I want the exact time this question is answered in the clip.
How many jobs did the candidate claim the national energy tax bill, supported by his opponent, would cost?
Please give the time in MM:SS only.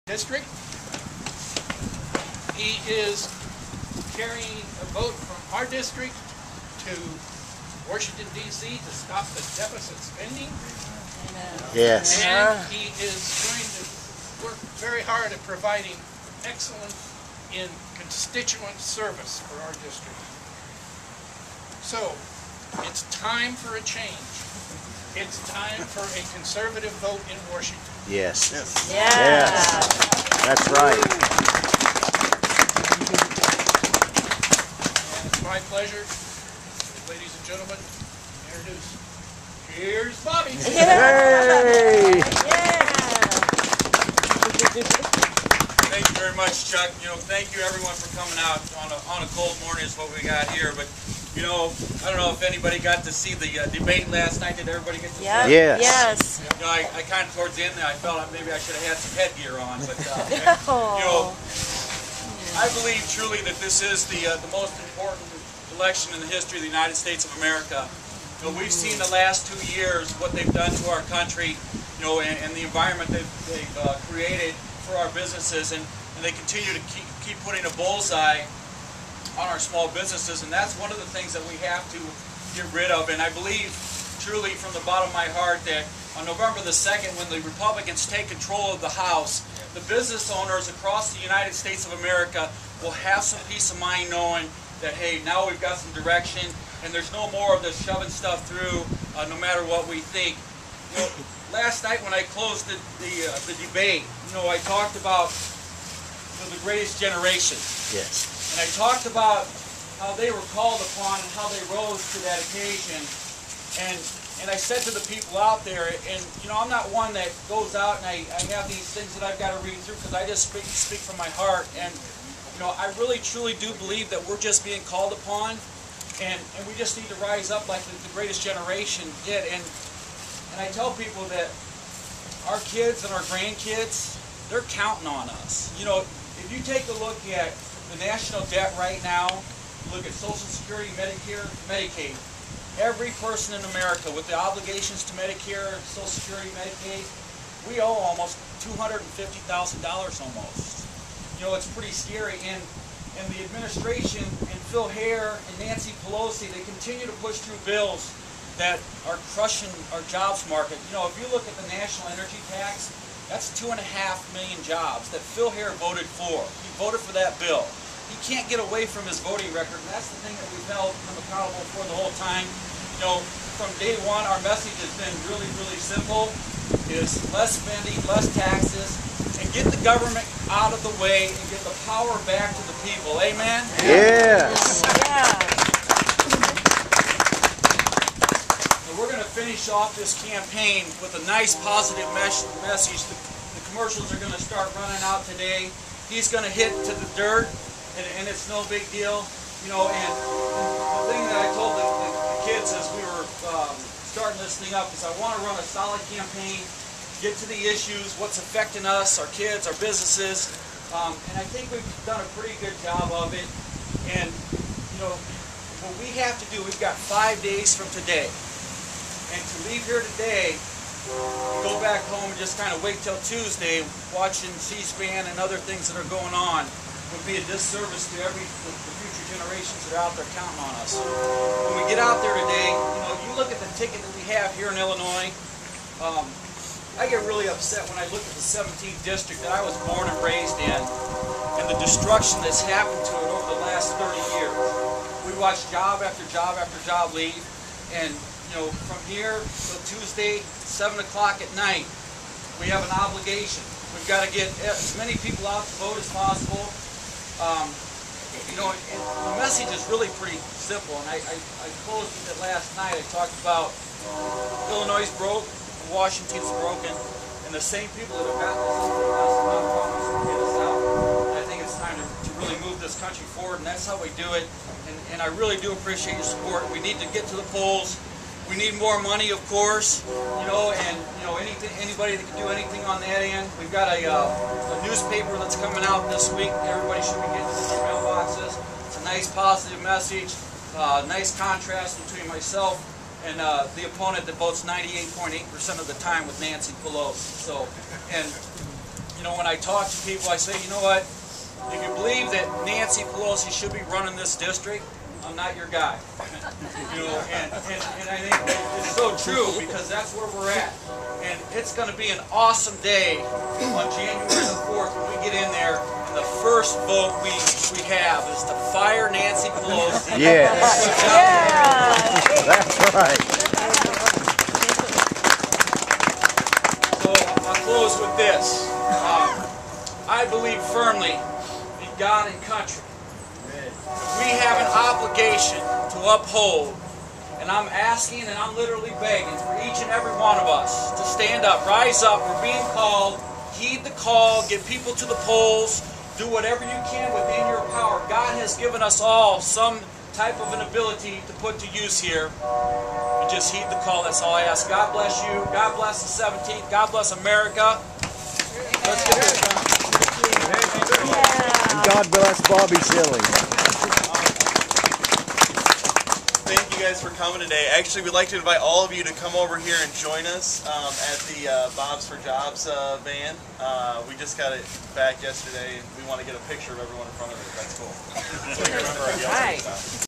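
02:43.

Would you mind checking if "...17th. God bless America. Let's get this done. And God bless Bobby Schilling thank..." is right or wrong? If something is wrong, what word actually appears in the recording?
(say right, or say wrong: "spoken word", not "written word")
right.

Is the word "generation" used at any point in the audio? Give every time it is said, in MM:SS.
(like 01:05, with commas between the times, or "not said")
01:46, 02:08, 03:49.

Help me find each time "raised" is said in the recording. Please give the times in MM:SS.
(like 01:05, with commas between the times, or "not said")
04:00.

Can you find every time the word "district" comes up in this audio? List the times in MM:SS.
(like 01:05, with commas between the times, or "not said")
00:00, 00:05, 00:19, 03:59, 05:04.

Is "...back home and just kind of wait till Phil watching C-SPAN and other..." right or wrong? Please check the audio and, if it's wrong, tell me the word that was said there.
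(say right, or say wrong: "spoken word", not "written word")
wrong: "Tuesday", not "Phil".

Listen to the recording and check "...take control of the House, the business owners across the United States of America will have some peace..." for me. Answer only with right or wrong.
right.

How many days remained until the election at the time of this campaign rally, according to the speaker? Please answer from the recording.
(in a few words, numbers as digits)
5.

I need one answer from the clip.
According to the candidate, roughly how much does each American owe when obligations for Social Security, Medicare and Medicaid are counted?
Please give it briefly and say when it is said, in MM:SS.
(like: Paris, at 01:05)
$250,000, at 02:28.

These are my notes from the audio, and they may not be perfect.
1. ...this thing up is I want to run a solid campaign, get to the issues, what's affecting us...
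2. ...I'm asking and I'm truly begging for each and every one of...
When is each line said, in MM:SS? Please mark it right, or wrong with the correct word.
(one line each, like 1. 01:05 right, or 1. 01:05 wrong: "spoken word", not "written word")
1. 03:24 right
2. 05:37 wrong: "literally", not "truly".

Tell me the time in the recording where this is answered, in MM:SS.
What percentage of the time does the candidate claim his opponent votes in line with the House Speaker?
04:54.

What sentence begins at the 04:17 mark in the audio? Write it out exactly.
Um, you know, the message is really pretty simple, and I, I, I closed with it last night.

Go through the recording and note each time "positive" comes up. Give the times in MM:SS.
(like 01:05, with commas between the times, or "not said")
03:11, 04:49.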